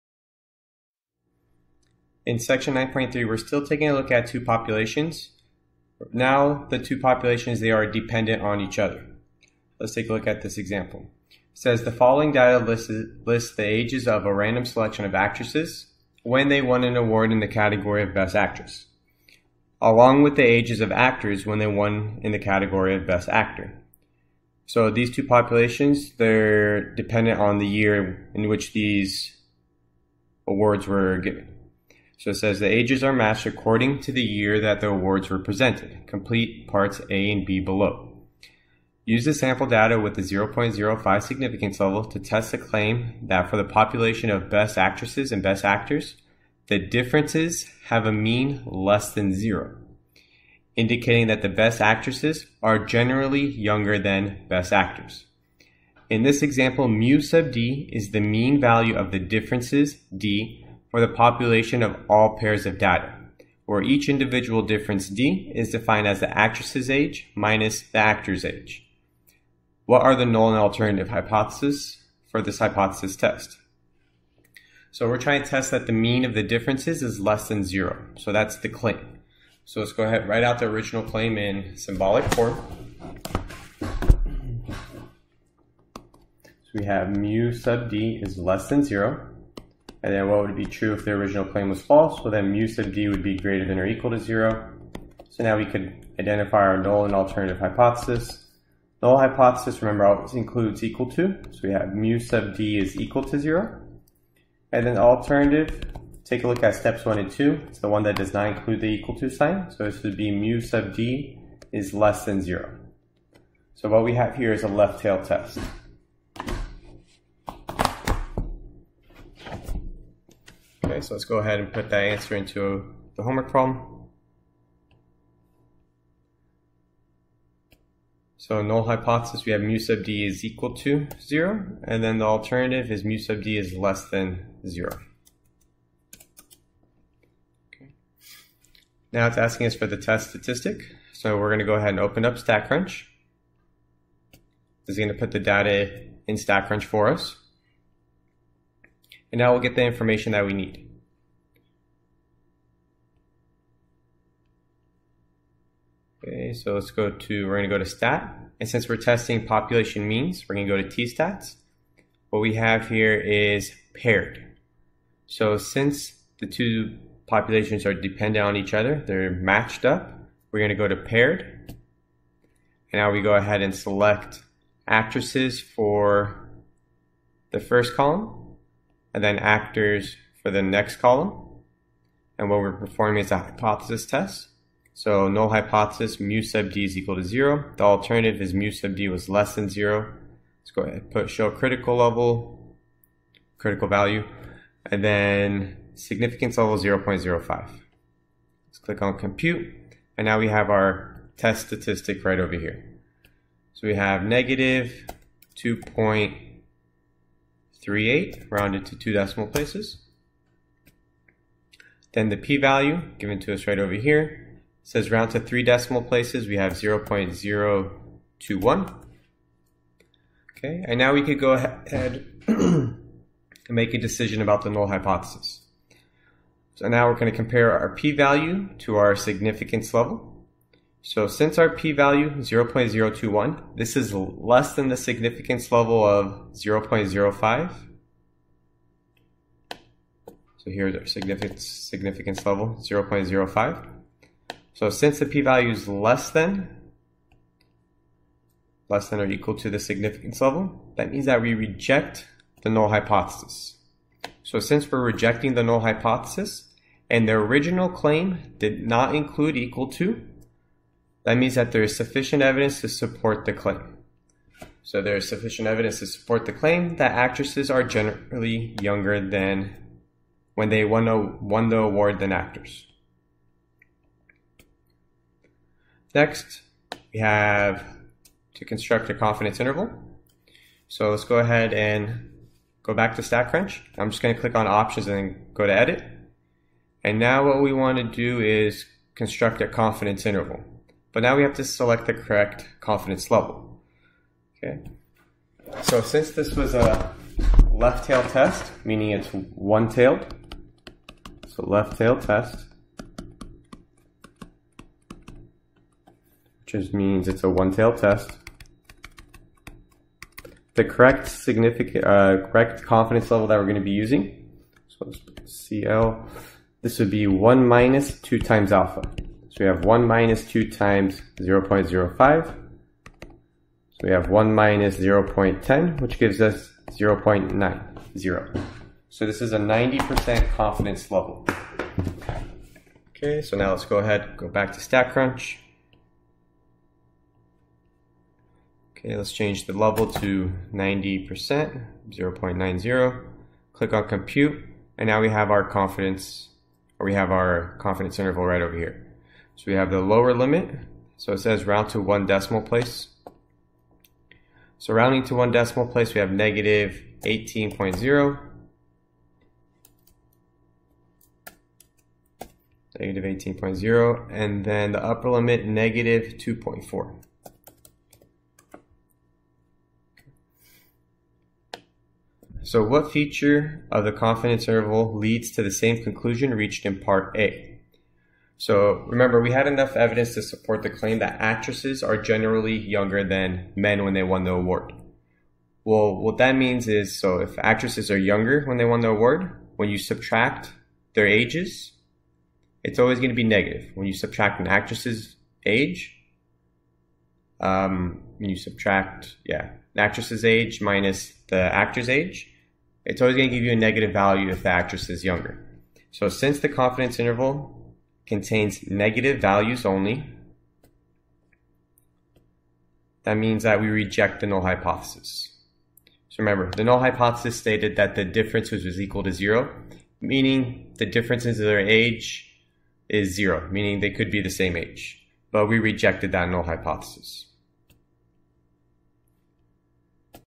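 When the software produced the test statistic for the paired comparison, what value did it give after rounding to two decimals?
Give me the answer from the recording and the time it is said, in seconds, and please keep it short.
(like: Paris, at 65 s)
-2.38, at 204 s.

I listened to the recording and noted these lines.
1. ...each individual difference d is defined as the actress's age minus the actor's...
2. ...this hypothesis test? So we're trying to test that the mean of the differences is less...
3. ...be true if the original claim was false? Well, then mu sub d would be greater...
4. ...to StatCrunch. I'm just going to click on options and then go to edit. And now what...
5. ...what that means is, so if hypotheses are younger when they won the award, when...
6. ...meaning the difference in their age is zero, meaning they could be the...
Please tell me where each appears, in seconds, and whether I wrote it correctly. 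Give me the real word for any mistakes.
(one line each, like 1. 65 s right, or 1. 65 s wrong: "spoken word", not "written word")
1. 63 s right
2. 72 s right
3. 90 s right
4. 283 s right
5. 386 s wrong: "actresses", not "hypotheses"
6. 420 s right.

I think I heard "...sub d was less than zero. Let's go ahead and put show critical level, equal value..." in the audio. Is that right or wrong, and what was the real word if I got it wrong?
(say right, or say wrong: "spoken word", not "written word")
wrong: "critical", not "equal".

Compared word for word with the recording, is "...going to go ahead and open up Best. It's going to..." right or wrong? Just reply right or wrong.
wrong.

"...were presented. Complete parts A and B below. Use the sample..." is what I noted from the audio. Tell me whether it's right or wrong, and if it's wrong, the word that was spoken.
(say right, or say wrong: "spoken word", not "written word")
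right.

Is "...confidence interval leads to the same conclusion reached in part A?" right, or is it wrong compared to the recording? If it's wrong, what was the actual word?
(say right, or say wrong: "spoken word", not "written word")
right.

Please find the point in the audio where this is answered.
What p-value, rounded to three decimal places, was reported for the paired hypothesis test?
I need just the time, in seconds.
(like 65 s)
216 s.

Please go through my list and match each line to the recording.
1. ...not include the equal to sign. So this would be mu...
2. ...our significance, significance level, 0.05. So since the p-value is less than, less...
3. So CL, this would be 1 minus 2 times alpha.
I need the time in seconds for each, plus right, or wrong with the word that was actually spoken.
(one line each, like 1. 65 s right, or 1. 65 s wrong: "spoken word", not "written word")
1. 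108 s right
2. 240 s right
3. 314 s right.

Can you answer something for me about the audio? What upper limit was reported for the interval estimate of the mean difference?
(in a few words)
-2.4.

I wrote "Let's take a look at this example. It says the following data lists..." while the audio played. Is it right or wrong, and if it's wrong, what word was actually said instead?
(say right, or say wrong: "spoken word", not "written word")
right.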